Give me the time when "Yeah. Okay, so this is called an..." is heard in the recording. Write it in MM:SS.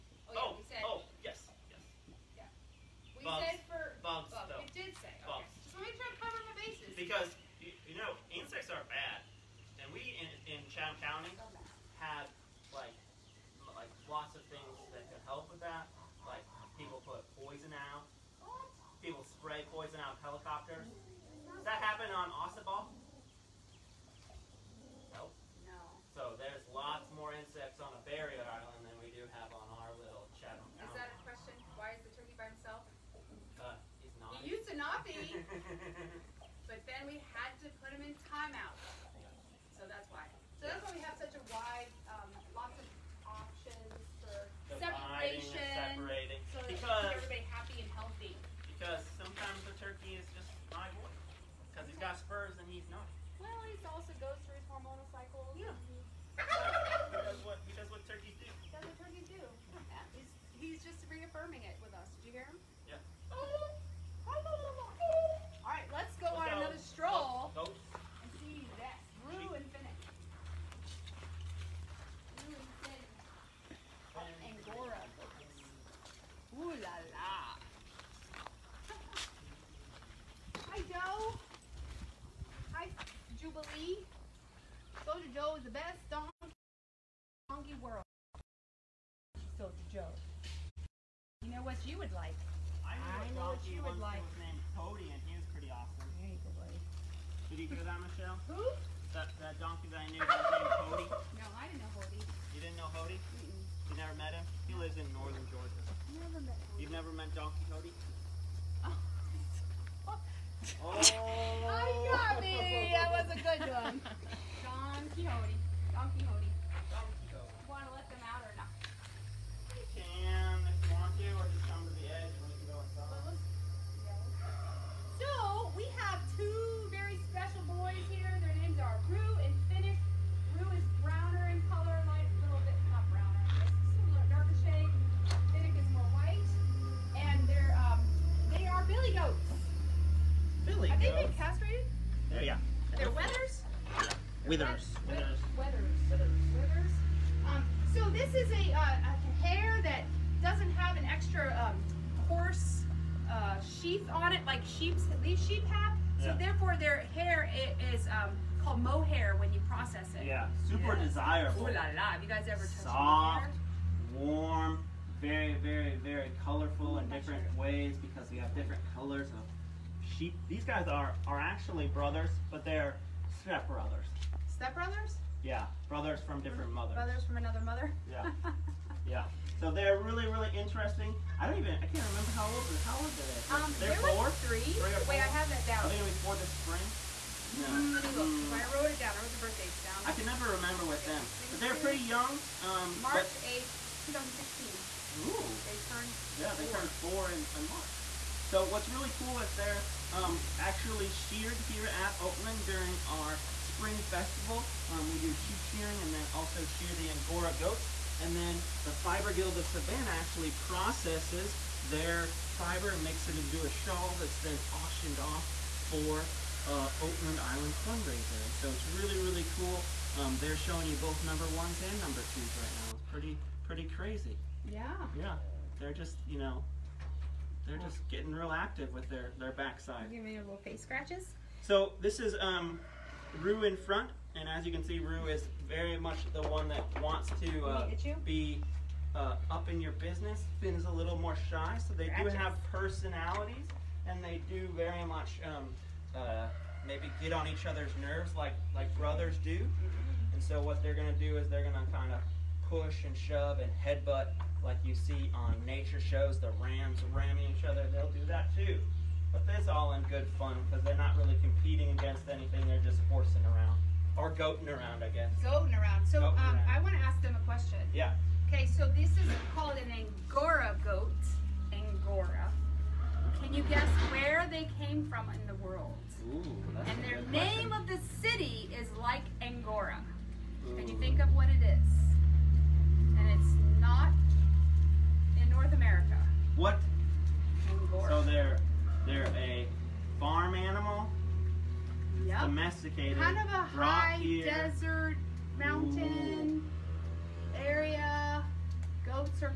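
04:27.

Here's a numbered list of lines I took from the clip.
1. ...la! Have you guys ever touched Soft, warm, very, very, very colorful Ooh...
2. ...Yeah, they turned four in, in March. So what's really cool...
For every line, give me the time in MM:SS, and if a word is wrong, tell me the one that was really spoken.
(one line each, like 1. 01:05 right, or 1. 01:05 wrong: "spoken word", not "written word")
1. 02:41 right
2. 03:16 right.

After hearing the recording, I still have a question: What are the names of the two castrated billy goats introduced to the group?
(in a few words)
Rue and Finnick.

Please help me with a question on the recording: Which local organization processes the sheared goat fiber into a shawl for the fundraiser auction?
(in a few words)
Fiber Guild of Savannah.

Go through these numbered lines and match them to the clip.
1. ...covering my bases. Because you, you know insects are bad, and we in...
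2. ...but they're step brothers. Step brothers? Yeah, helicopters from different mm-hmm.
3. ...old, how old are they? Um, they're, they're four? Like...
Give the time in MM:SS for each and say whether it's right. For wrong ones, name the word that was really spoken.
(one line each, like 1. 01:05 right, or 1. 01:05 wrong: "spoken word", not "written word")
1. 00:06 right
2. 02:52 wrong: "brothers", not "helicopters"
3. 03:02 right.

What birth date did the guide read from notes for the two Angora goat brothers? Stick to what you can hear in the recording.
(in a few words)
March 8th, 2016.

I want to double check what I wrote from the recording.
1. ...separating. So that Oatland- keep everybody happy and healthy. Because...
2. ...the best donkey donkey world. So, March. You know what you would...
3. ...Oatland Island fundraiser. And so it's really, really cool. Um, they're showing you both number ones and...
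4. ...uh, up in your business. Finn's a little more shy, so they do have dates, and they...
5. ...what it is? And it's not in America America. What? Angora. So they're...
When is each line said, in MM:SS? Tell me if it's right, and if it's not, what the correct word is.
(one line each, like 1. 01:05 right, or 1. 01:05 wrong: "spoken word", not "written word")
1. 00:46 wrong: "Because", not "Oatland"
2. 01:25 wrong: "Joe", not "March"
3. 03:37 right
4. 03:59 wrong: "personalities", not "dates"
5. 04:41 wrong: "North", not "America".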